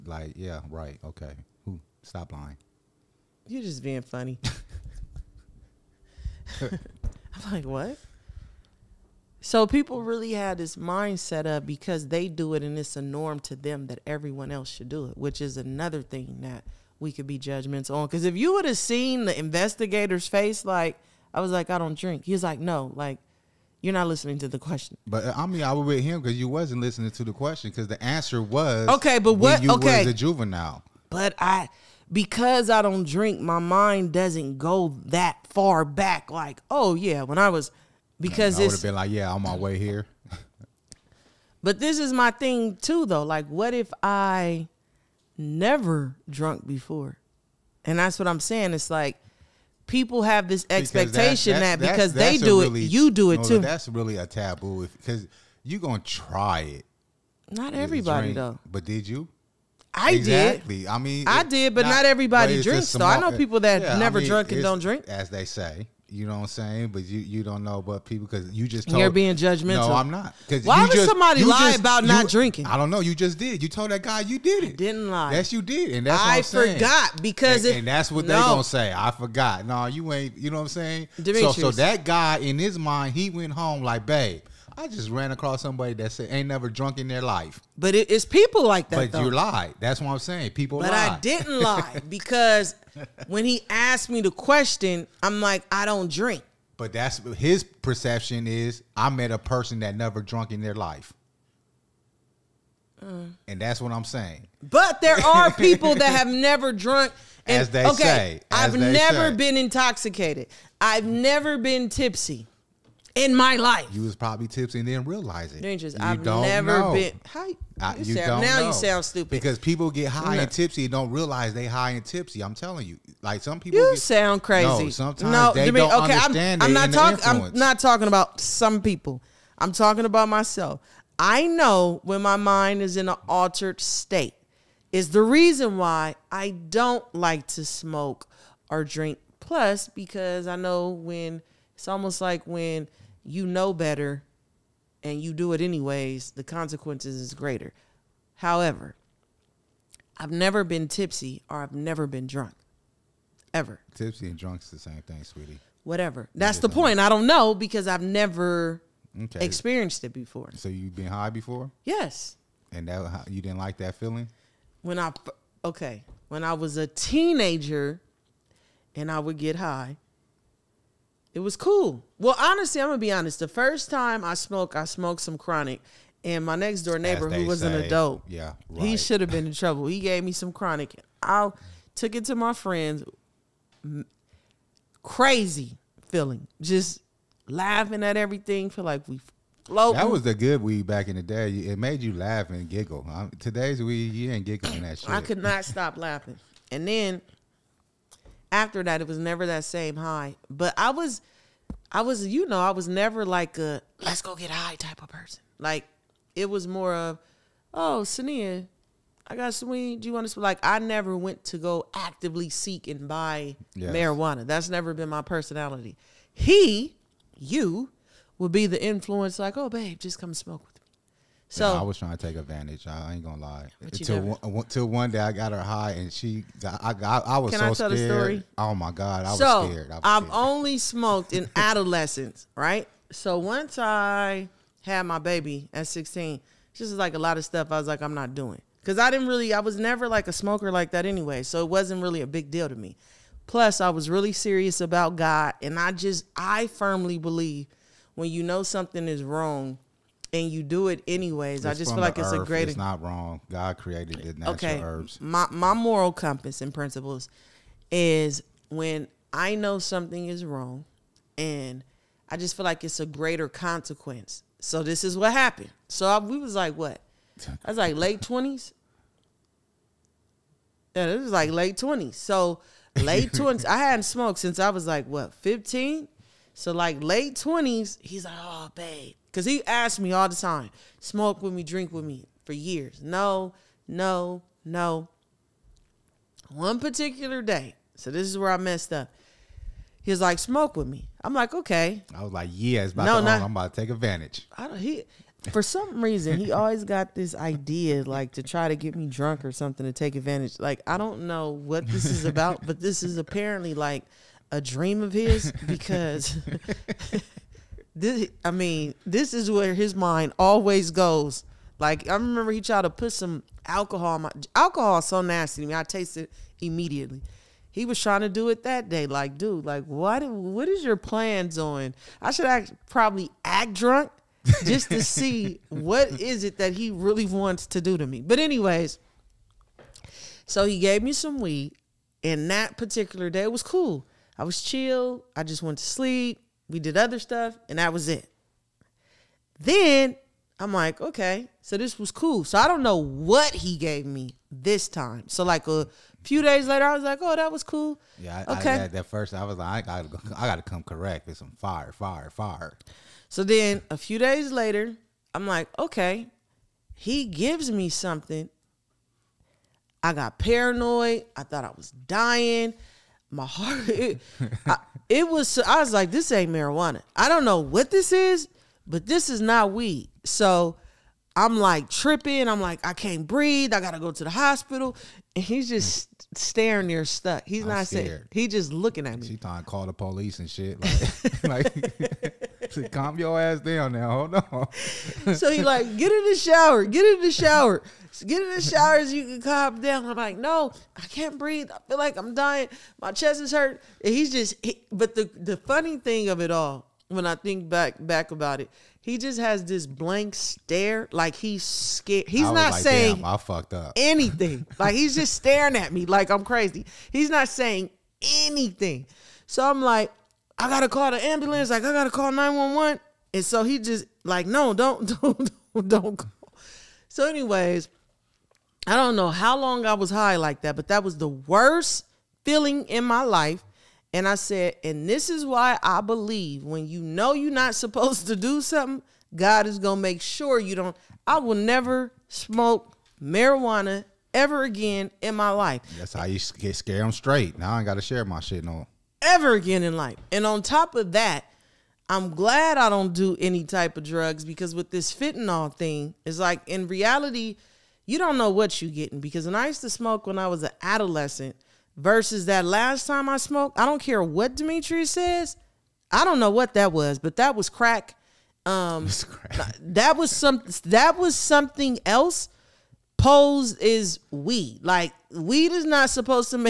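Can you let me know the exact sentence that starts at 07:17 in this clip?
Now I ain't gotta share my shit no ever again in life.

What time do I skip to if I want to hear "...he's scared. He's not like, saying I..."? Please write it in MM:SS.
06:41.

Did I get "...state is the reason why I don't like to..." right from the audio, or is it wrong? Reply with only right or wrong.
right.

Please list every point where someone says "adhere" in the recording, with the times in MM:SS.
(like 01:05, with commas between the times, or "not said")
not said.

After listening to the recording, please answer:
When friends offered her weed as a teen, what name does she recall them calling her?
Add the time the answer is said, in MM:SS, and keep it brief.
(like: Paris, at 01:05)
Saniyyah, at 03:28.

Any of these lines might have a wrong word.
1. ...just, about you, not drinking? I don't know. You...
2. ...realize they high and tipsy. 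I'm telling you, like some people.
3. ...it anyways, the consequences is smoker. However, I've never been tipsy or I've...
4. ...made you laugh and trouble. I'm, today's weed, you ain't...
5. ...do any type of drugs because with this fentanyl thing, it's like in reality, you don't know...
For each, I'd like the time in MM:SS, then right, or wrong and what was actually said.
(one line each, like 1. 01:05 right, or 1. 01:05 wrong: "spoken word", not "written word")
1. 01:11 right
2. 02:01 right
3. 02:25 wrong: "greater", not "smoker"
4. 03:11 wrong: "giggle", not "trouble"
5. 07:23 right.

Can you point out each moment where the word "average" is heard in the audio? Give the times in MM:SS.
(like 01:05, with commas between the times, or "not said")
not said.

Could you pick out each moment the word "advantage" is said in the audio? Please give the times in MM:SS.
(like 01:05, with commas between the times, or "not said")
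03:42, 04:53, 05:00.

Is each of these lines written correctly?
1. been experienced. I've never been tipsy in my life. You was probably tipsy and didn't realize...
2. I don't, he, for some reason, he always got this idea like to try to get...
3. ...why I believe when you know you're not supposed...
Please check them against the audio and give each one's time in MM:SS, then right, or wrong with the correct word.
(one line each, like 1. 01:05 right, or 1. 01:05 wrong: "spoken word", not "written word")
1. 01:49 wrong: "intoxicated", not "experienced"
2. 04:54 right
3. 07:05 right.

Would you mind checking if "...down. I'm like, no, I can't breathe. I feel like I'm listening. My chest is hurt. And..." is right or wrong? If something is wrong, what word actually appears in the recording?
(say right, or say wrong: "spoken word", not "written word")
wrong: "dying", not "listening".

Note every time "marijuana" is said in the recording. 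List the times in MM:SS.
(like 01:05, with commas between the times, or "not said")
03:33, 06:06, 07:13.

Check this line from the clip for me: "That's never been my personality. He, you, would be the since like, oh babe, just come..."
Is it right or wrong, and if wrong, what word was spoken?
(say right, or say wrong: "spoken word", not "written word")
wrong: "influence", not "since".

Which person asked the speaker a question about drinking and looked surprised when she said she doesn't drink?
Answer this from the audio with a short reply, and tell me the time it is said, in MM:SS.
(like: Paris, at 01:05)
the investigator, at 00:19.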